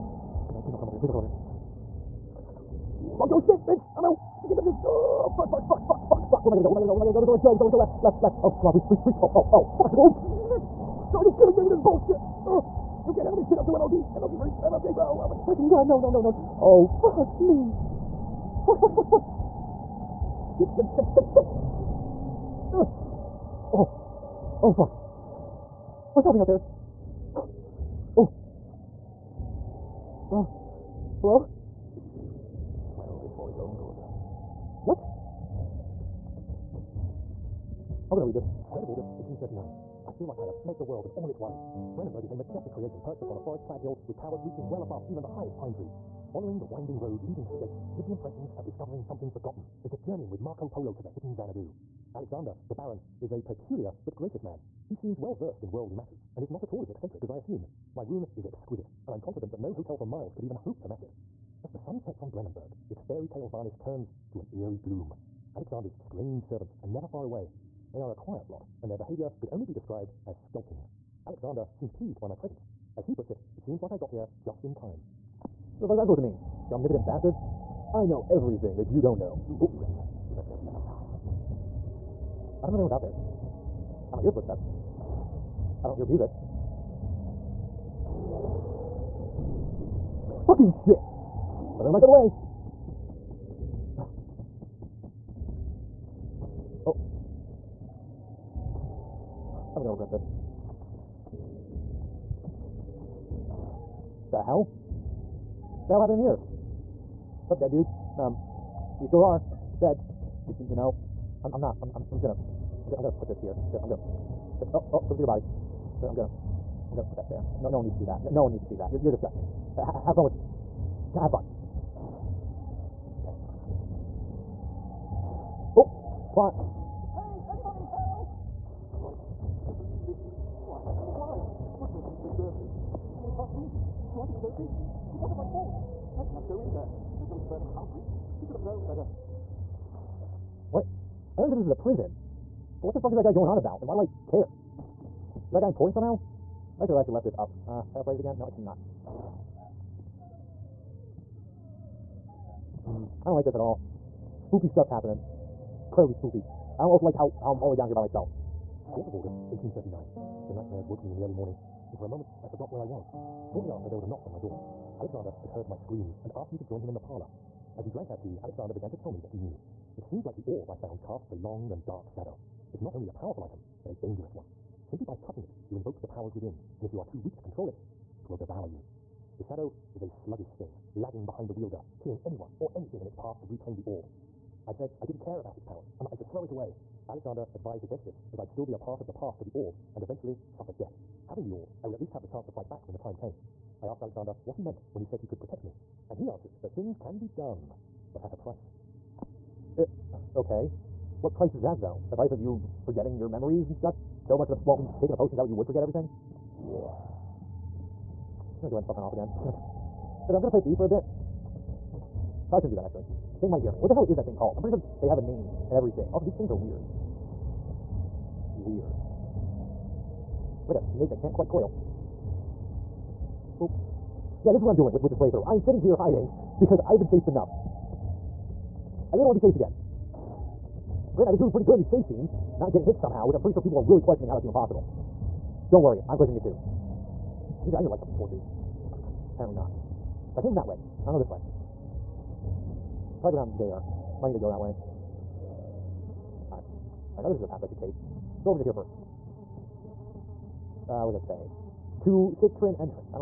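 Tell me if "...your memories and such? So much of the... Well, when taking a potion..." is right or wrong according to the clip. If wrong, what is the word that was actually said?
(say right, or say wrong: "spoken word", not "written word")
right.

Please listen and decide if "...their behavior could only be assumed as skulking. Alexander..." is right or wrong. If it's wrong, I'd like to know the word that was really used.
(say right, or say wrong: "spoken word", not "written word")
wrong: "described", not "assumed".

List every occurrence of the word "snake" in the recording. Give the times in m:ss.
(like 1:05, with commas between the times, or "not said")
3:40.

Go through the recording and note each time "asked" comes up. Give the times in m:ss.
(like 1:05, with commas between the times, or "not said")
2:46, 3:13.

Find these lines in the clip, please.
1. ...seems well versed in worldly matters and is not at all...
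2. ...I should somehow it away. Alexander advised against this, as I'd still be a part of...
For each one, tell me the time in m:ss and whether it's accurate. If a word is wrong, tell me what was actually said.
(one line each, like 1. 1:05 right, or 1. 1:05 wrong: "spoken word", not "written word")
1. 0:54 right
2. 3:06 wrong: "throw", not "somehow".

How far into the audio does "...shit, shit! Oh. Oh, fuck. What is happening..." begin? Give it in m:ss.
0:21.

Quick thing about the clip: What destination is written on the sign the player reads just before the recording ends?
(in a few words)
Cistern.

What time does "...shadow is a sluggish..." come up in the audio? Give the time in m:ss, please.
2:59.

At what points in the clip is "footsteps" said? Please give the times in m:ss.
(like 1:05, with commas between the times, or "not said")
1:24.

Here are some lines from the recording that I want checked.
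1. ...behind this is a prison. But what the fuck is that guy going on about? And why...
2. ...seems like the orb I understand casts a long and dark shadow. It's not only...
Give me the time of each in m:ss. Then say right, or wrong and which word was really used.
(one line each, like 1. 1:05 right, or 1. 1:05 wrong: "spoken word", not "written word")
1. 2:21 wrong: "understand", not "behind"
2. 2:50 wrong: "found", not "understand".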